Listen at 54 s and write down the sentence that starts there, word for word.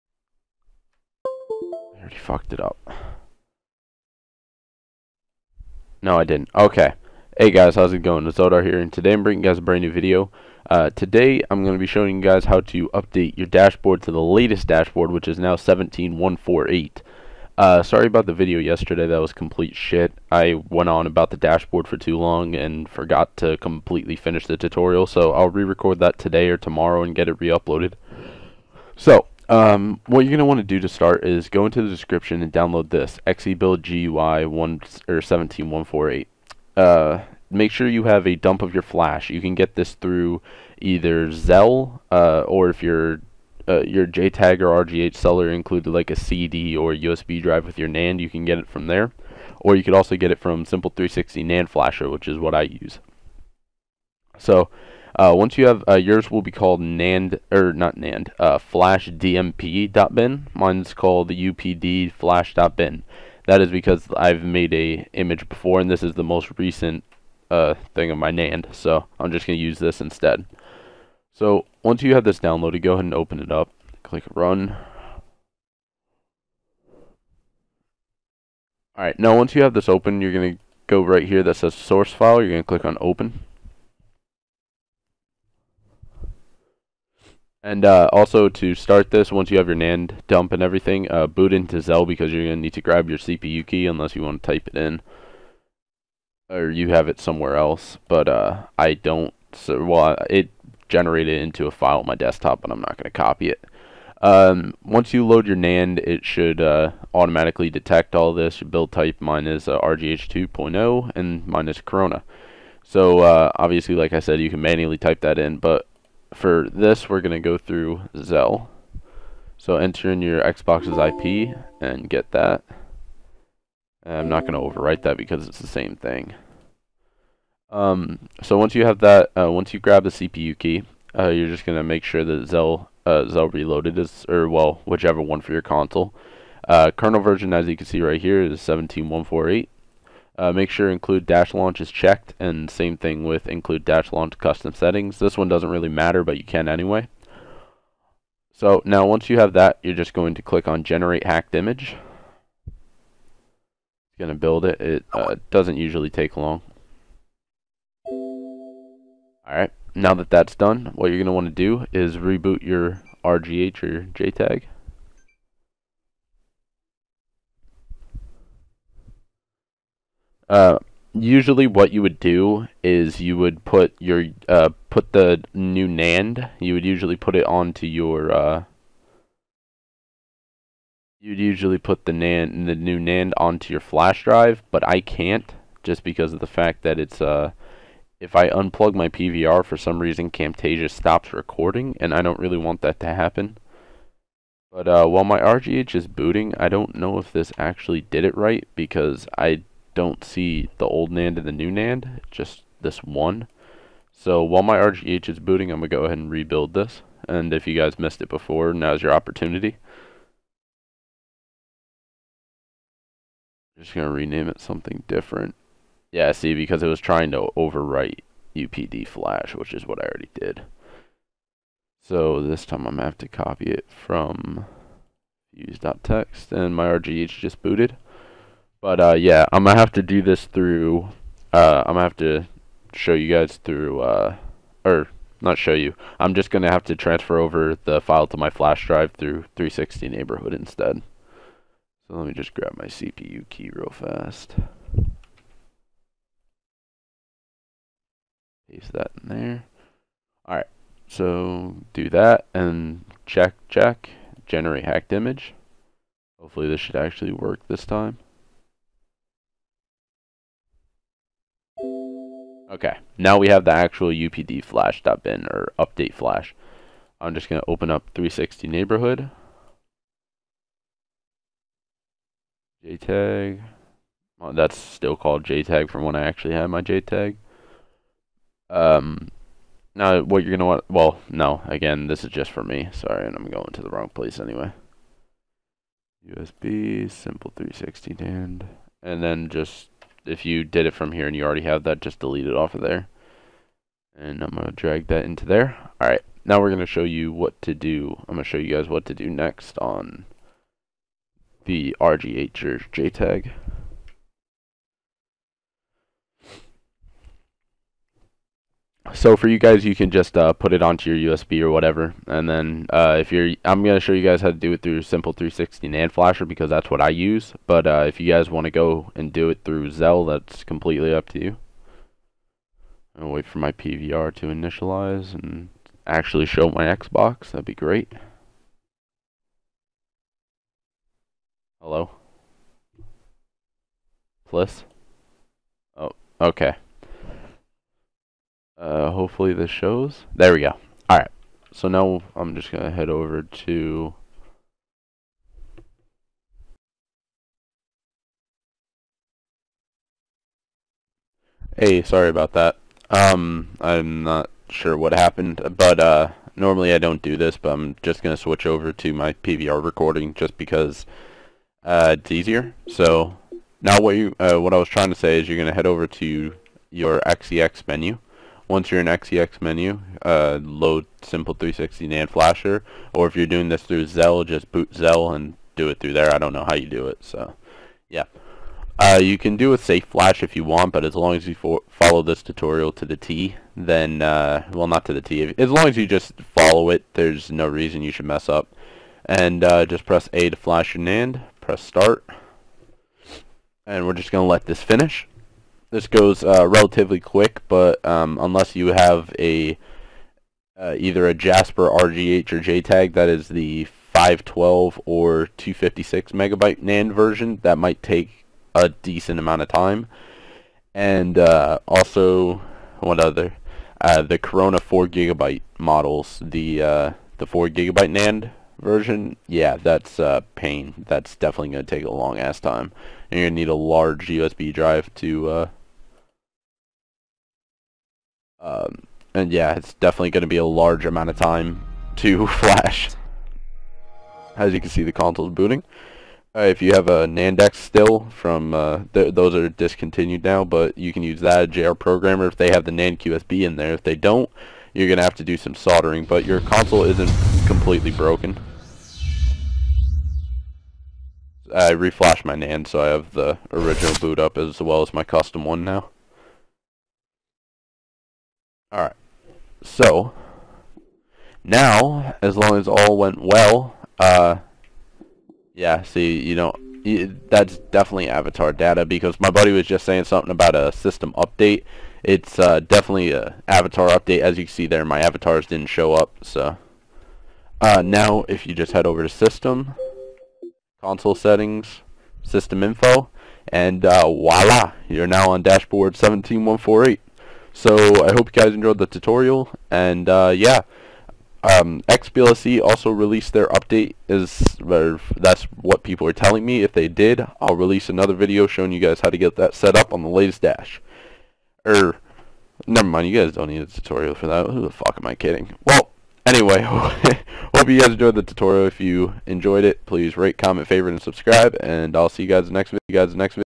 So uh, once you have uh, yours will be called NAND or not NAND uh, flash dmp.bin.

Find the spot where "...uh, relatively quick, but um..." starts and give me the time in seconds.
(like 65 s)
396 s.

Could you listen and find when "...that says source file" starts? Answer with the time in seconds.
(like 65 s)
81 s.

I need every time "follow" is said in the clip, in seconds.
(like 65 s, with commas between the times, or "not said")
381 s, 386 s.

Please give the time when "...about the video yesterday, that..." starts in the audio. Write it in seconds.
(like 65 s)
18 s.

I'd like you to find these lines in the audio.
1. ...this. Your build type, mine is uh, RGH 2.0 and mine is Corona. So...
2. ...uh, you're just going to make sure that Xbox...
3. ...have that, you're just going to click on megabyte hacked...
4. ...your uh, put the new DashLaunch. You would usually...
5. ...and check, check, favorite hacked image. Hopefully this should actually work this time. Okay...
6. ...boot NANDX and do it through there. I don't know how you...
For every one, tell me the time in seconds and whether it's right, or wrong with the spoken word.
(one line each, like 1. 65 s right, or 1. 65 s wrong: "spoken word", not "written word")
1. 108 s right
2. 131 s wrong: "XeLL", not "Xbox"
3. 149 s wrong: "generate", not "megabyte"
4. 173 s wrong: "NAND", not "DashLaunch"
5. 252 s wrong: "generate", not "favorite"
6. 374 s wrong: "XeLL", not "NANDX".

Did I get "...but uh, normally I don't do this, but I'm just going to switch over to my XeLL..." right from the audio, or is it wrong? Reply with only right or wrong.
wrong.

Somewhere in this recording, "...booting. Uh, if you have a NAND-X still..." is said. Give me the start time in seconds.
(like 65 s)
435 s.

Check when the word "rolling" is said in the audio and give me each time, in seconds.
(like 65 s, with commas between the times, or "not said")
not said.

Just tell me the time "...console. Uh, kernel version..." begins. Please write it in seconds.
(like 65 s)
135 s.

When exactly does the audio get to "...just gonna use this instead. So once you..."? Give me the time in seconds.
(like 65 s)
69 s.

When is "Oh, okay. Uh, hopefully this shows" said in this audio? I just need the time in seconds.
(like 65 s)
335 s.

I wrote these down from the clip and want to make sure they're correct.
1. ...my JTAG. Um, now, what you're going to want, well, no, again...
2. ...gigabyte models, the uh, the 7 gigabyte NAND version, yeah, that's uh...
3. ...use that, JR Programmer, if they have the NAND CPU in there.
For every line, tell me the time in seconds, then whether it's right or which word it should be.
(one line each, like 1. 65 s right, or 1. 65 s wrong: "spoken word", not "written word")
1. 276 s right
2. 415 s wrong: "4", not "7"
3. 441 s wrong: "QSB", not "CPU".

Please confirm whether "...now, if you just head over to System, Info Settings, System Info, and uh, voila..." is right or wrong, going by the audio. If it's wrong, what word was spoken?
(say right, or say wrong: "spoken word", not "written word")
wrong: "Console", not "Info".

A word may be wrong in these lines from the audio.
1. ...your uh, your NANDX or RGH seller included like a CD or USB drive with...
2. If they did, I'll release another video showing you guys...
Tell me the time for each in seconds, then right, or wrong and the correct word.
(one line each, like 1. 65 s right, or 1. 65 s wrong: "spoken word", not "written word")
1. 42 s wrong: "JTAG", not "NANDX"
2. 496 s right.